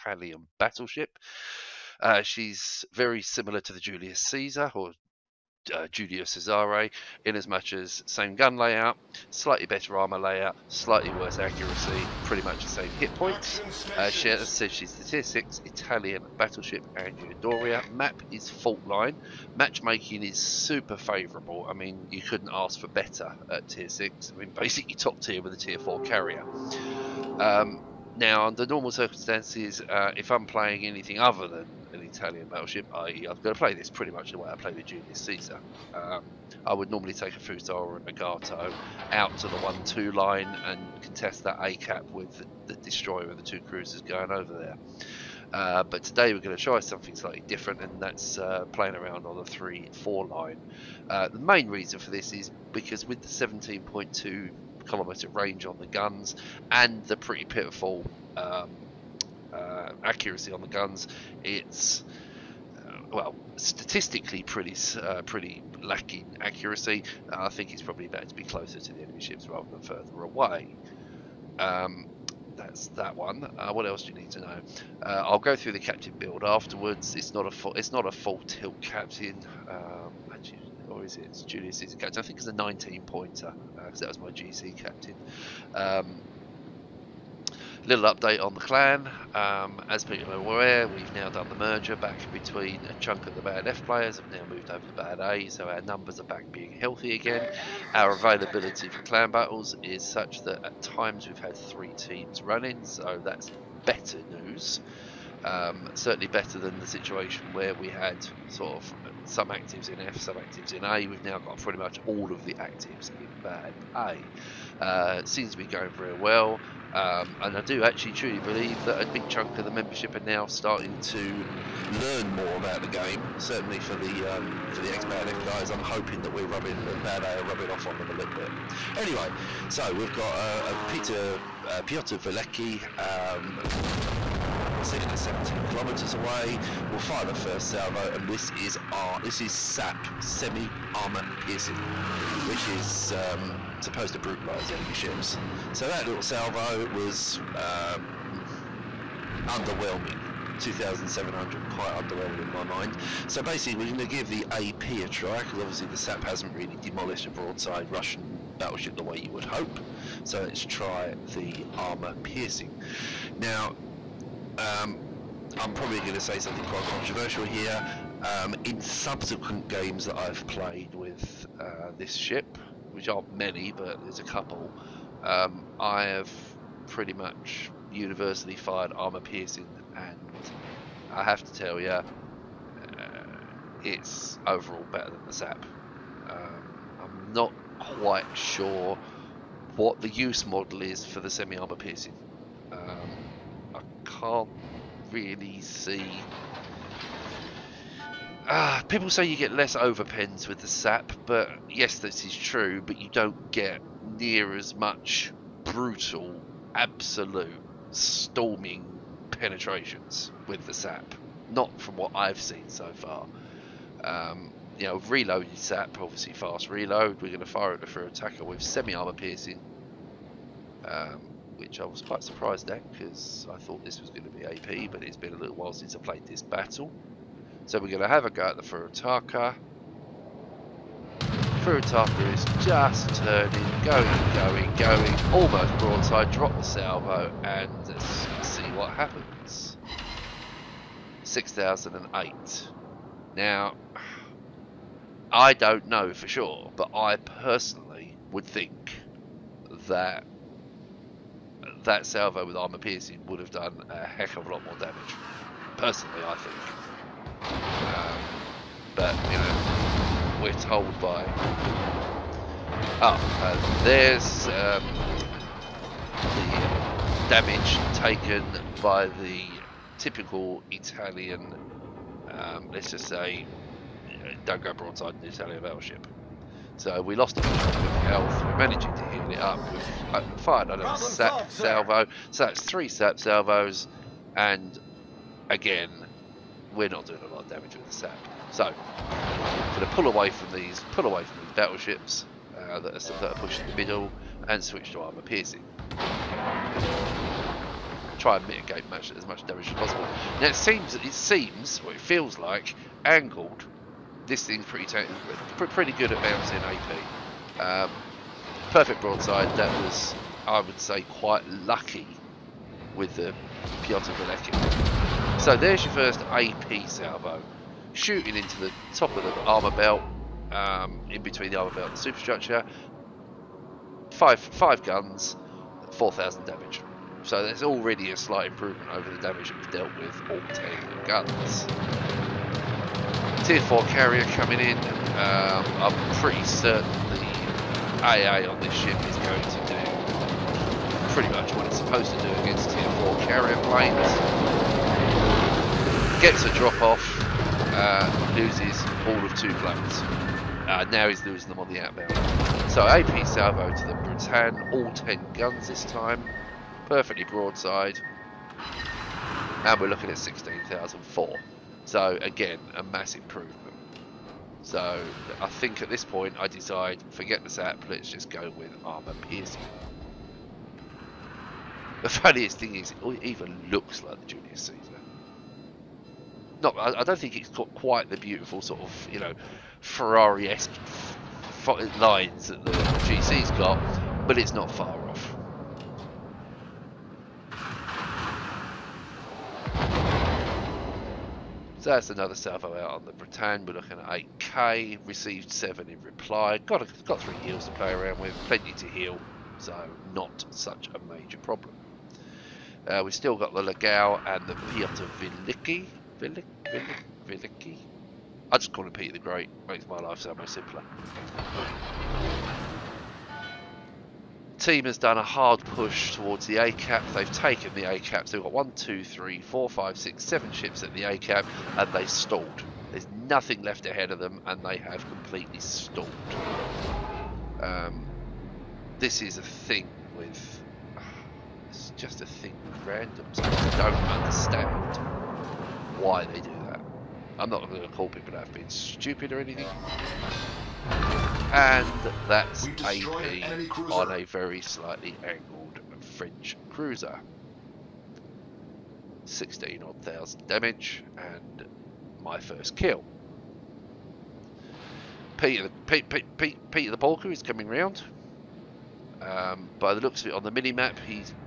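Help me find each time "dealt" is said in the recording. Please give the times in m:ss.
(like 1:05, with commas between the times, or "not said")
5:29.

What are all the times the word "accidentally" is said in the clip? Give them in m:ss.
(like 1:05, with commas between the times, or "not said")
not said.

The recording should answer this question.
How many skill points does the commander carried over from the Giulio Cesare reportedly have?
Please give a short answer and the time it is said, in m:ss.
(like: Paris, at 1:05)
19, at 1:22.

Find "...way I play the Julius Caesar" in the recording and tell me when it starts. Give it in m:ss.
0:34.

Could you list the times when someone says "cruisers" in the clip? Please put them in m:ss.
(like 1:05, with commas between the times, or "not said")
0:43, 7:26.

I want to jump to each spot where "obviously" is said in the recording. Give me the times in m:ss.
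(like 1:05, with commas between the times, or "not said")
2:35, 3:35.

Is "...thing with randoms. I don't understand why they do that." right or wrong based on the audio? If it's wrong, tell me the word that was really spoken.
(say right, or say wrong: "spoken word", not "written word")
right.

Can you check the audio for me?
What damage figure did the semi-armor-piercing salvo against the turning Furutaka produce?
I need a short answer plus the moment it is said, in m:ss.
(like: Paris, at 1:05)
6008, at 4:01.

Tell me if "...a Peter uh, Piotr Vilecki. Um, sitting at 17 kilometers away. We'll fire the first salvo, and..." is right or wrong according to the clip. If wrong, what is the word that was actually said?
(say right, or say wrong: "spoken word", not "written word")
right.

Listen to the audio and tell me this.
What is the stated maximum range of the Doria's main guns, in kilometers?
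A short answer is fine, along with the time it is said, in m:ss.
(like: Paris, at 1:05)
17.2, at 0:53.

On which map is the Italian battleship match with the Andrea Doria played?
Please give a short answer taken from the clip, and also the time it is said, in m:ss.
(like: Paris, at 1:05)
Fault Line, at 0:18.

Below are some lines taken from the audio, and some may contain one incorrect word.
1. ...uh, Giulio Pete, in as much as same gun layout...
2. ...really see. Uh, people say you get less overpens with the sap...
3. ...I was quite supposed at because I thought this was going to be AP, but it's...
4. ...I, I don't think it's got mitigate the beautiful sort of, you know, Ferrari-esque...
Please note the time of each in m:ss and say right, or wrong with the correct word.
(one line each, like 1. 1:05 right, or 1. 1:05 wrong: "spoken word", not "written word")
1. 0:05 wrong: "Cesare", not "Pete"
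2. 3:15 right
3. 3:41 wrong: "surprised", not "supposed"
4. 6:16 wrong: "quite", not "mitigate".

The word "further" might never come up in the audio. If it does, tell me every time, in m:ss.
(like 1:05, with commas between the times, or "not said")
1:09.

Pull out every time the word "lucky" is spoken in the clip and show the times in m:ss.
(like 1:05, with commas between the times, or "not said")
5:11.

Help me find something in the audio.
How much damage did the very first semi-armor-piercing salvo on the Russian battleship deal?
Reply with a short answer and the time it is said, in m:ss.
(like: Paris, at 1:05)
2,700, at 2:30.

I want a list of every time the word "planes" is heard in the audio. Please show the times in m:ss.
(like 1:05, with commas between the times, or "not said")
5:43, 5:49.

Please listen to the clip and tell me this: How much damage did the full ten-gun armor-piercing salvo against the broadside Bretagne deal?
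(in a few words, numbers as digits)
16,004.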